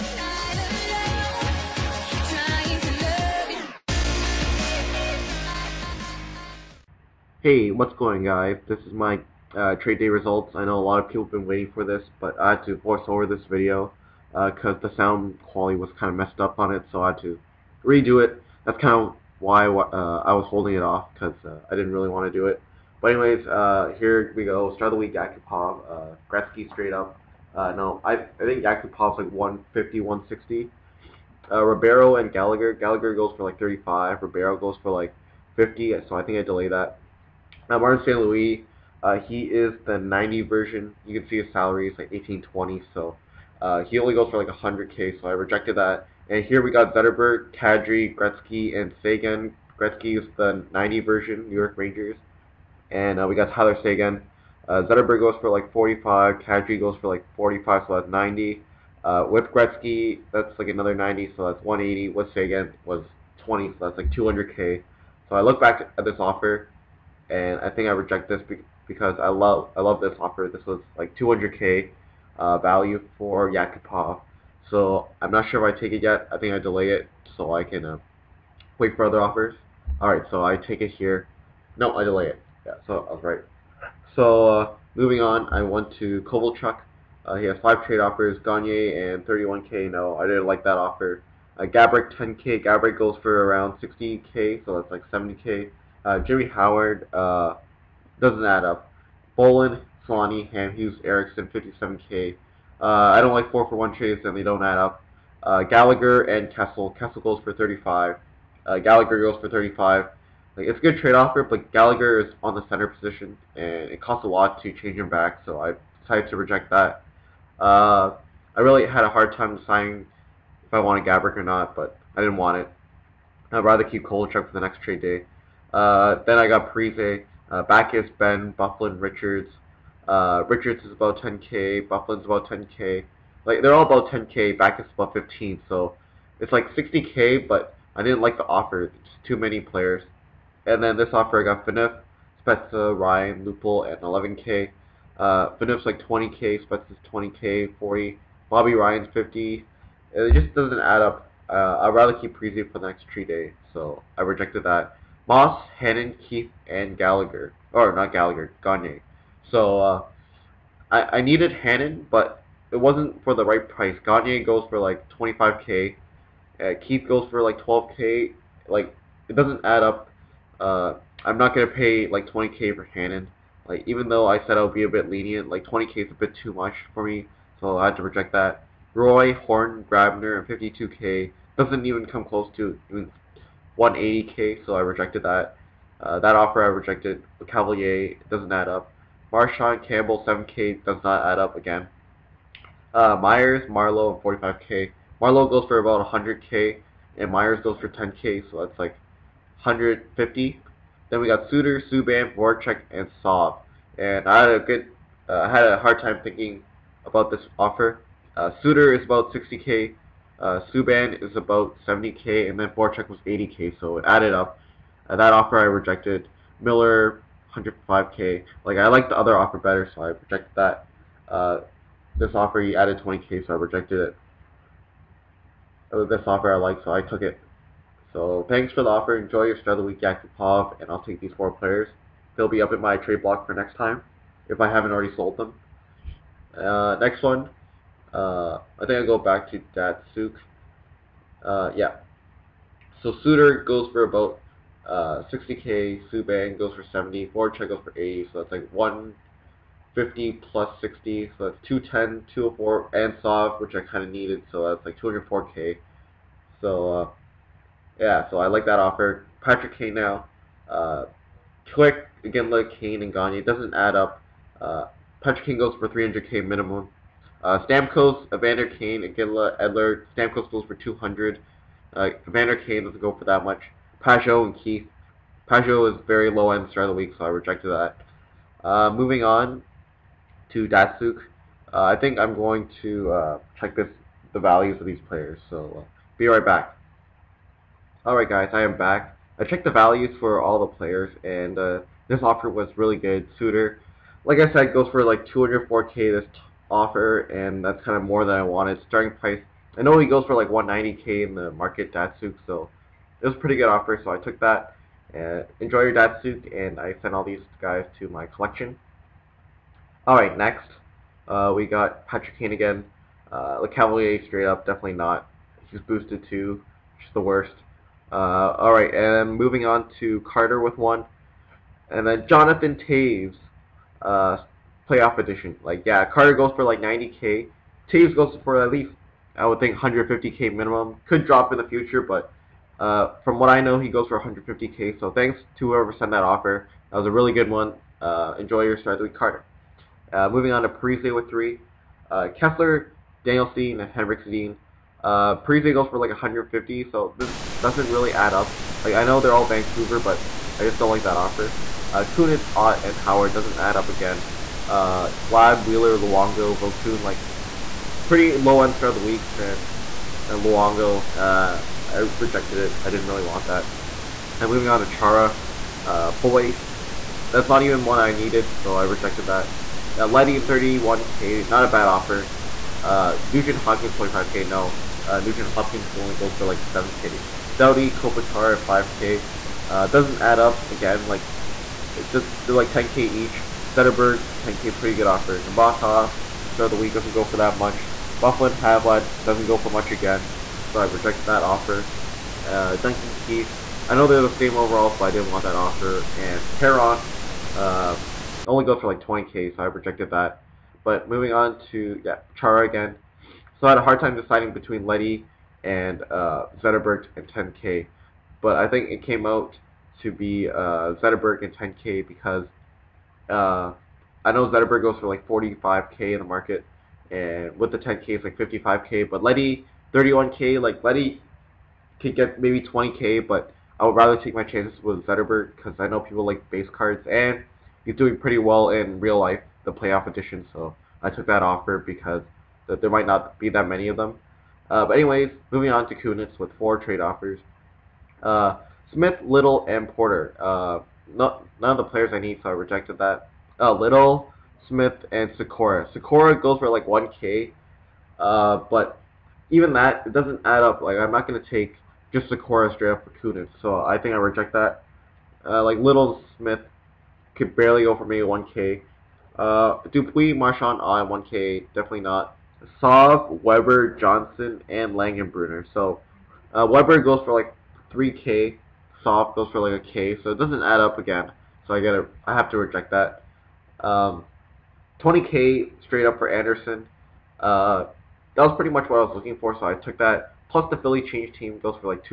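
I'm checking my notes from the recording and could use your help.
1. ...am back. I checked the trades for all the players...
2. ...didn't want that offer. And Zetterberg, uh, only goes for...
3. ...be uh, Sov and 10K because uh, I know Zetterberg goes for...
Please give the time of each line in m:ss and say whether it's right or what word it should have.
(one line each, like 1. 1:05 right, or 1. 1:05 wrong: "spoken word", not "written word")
1. 4:48 wrong: "values", not "trades"
2. 6:35 wrong: "Perron", not "Zetterberg"
3. 6:50 wrong: "Zetterberg", not "Sov".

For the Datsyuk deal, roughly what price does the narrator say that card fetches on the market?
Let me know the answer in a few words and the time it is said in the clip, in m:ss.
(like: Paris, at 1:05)
190k, at 5:00.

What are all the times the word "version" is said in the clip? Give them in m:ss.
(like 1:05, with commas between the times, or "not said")
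0:40, 0:50.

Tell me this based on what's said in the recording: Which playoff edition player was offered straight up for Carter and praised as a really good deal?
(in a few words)
Jonathan Toews.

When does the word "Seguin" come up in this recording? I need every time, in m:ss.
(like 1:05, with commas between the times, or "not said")
0:49, 0:53, 1:02.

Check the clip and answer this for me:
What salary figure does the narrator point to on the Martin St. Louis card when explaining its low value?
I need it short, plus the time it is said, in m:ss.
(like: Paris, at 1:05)
1820, at 0:42.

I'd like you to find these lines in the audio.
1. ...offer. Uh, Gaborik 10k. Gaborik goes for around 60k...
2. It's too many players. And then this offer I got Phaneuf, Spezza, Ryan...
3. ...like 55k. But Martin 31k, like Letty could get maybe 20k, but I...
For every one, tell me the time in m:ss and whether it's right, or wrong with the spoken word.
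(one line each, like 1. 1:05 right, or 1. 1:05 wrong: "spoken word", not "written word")
1. 1:30 right
2. 2:18 right
3. 6:58 wrong: "Letty", not "Martin".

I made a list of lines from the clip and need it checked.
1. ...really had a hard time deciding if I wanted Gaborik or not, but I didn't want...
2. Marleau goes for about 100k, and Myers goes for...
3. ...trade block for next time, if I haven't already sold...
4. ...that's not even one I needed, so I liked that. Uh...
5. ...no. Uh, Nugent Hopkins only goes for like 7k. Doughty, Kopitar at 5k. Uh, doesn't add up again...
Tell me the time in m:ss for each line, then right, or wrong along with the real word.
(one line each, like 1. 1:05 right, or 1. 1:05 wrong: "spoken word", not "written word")
1. 1:58 right
2. 3:15 right
3. 3:52 right
4. 6:07 wrong: "rejected", not "liked"
5. 6:14 right.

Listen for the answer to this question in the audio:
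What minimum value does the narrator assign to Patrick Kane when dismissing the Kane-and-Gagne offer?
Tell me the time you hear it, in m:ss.
4:25.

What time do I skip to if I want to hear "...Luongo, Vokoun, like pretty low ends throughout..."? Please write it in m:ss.
5:55.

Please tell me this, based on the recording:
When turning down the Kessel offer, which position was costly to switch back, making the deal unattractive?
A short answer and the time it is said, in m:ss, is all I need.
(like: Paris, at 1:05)
Center, at 1:52.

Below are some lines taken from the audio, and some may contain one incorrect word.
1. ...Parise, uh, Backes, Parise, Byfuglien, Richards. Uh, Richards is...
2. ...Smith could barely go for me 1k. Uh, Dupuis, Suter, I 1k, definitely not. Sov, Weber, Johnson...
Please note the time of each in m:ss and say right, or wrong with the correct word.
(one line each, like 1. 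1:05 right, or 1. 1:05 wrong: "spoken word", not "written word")
1. 2:06 wrong: "Ben", not "Parise"
2. 7:36 wrong: "Marchand", not "Suter".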